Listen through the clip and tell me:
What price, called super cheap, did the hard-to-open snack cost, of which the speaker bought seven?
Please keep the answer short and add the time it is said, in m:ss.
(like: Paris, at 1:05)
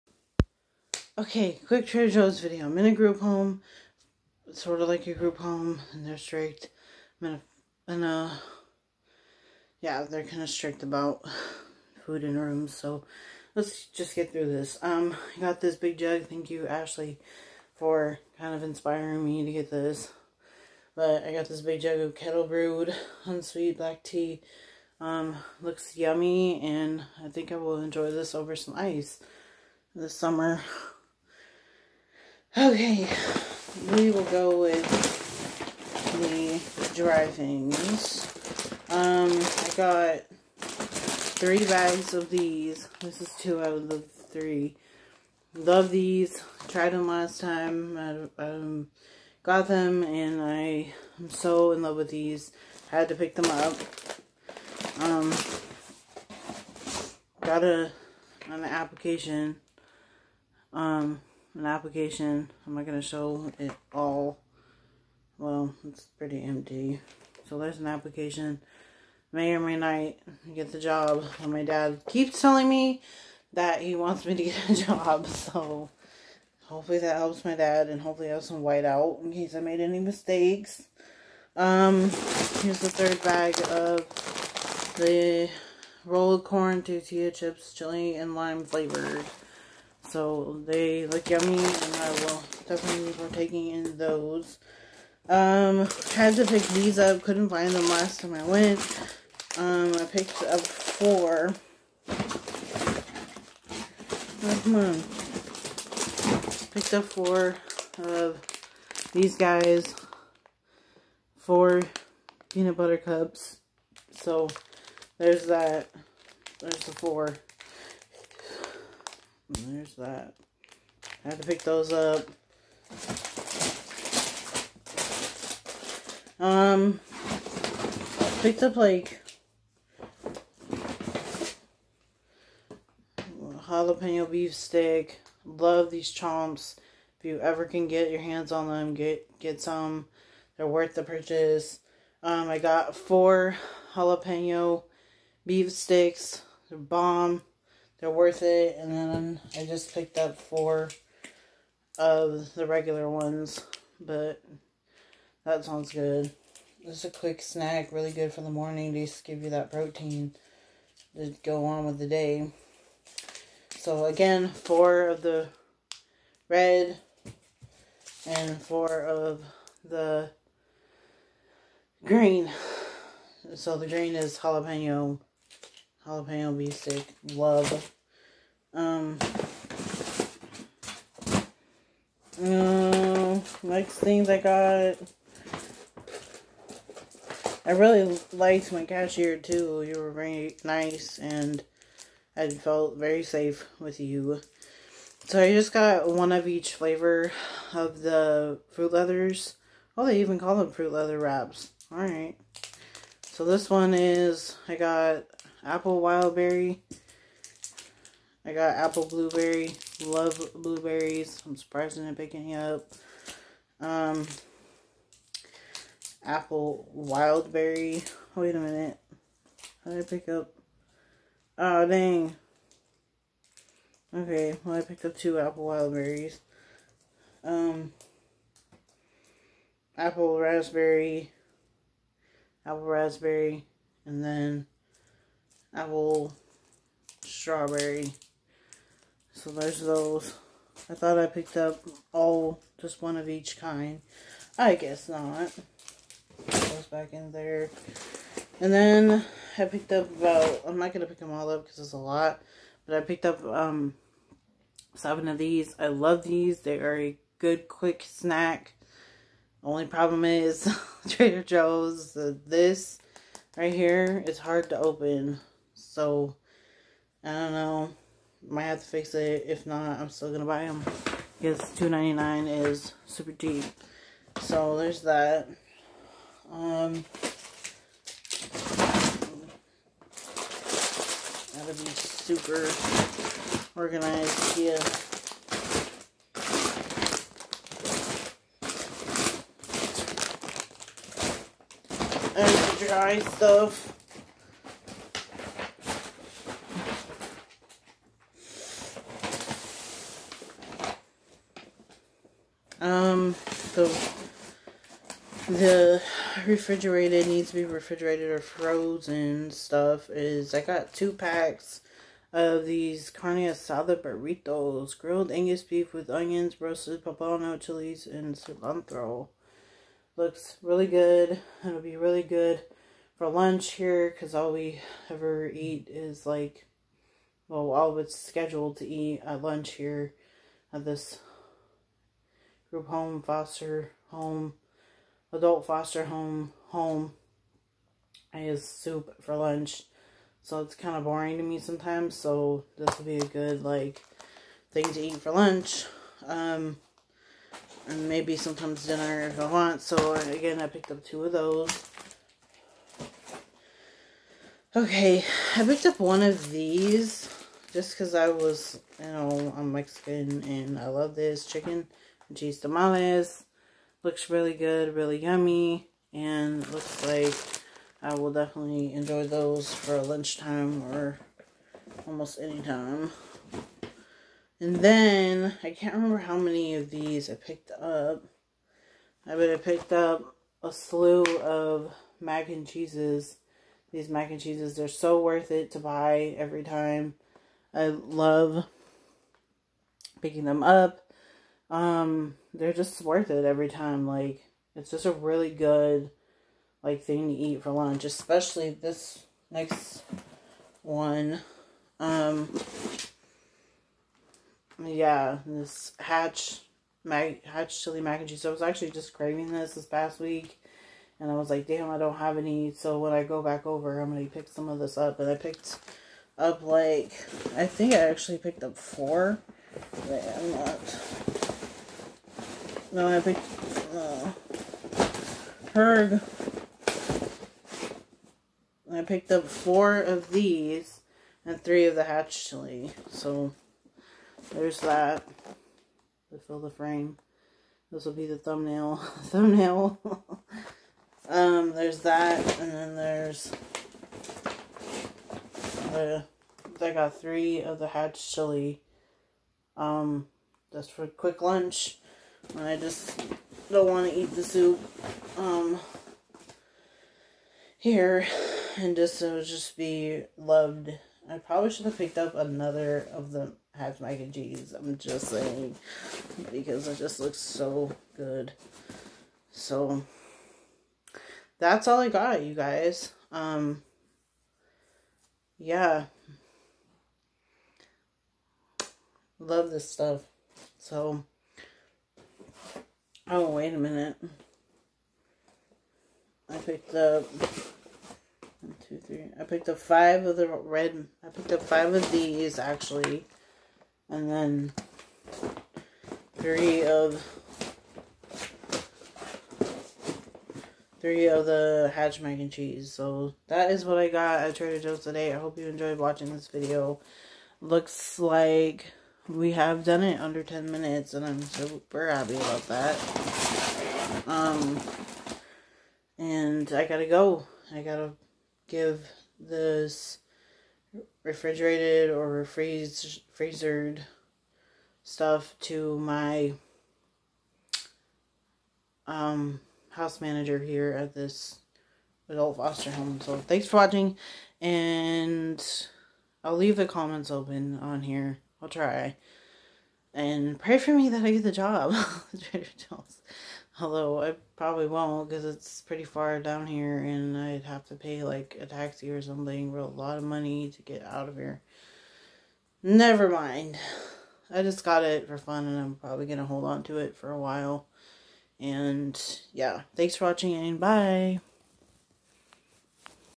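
$2.99, at 4:31.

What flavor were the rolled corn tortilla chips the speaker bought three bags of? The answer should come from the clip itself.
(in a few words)
Chili and lime.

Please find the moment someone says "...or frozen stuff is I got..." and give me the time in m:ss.
5:08.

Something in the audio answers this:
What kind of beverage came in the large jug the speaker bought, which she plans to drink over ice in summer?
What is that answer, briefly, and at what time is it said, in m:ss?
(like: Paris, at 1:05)
Kettle brewed unsweet black tea, at 0:22.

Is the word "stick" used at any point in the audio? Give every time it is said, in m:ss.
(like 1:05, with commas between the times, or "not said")
2:14, 2:25, 2:56.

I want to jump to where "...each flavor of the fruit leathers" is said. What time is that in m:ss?
3:16.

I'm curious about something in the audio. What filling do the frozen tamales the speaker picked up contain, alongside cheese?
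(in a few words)
Chicken.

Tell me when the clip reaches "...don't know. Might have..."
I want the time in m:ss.
4:27.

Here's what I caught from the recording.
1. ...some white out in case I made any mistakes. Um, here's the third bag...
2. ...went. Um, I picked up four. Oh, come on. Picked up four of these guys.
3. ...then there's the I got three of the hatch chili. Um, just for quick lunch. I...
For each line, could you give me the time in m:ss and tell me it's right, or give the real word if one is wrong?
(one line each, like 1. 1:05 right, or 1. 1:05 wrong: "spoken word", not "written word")
1. 1:18 right
2. 1:38 right
3. 7:22 right.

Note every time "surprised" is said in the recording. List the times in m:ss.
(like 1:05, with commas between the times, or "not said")
3:31.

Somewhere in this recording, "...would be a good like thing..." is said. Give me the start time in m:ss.
5:42.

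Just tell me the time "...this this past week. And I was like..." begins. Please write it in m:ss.
6:49.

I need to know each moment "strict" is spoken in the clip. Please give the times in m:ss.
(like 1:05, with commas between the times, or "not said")
0:06, 0:10.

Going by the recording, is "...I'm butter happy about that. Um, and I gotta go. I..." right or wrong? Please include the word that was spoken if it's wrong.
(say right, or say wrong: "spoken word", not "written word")
wrong: "super", not "butter".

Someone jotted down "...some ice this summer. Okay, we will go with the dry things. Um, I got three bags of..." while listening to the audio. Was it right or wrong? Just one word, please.
right.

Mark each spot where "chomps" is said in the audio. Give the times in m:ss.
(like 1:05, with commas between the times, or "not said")
2:16.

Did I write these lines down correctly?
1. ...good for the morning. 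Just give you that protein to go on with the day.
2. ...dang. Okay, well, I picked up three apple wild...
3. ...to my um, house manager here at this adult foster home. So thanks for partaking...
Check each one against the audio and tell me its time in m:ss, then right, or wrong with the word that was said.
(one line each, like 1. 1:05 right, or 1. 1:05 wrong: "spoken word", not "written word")
1. 2:38 right
2. 3:41 wrong: "two", not "three"
3. 8:45 wrong: "watching", not "partaking".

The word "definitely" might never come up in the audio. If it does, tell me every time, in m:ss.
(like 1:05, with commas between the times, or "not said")
1:32, 6:08.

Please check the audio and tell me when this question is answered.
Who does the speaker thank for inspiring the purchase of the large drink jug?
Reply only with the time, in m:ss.
0:16.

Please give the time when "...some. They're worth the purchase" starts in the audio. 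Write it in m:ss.
2:19.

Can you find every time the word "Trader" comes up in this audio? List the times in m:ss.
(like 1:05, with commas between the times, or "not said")
0:01, 4:21, 8:24.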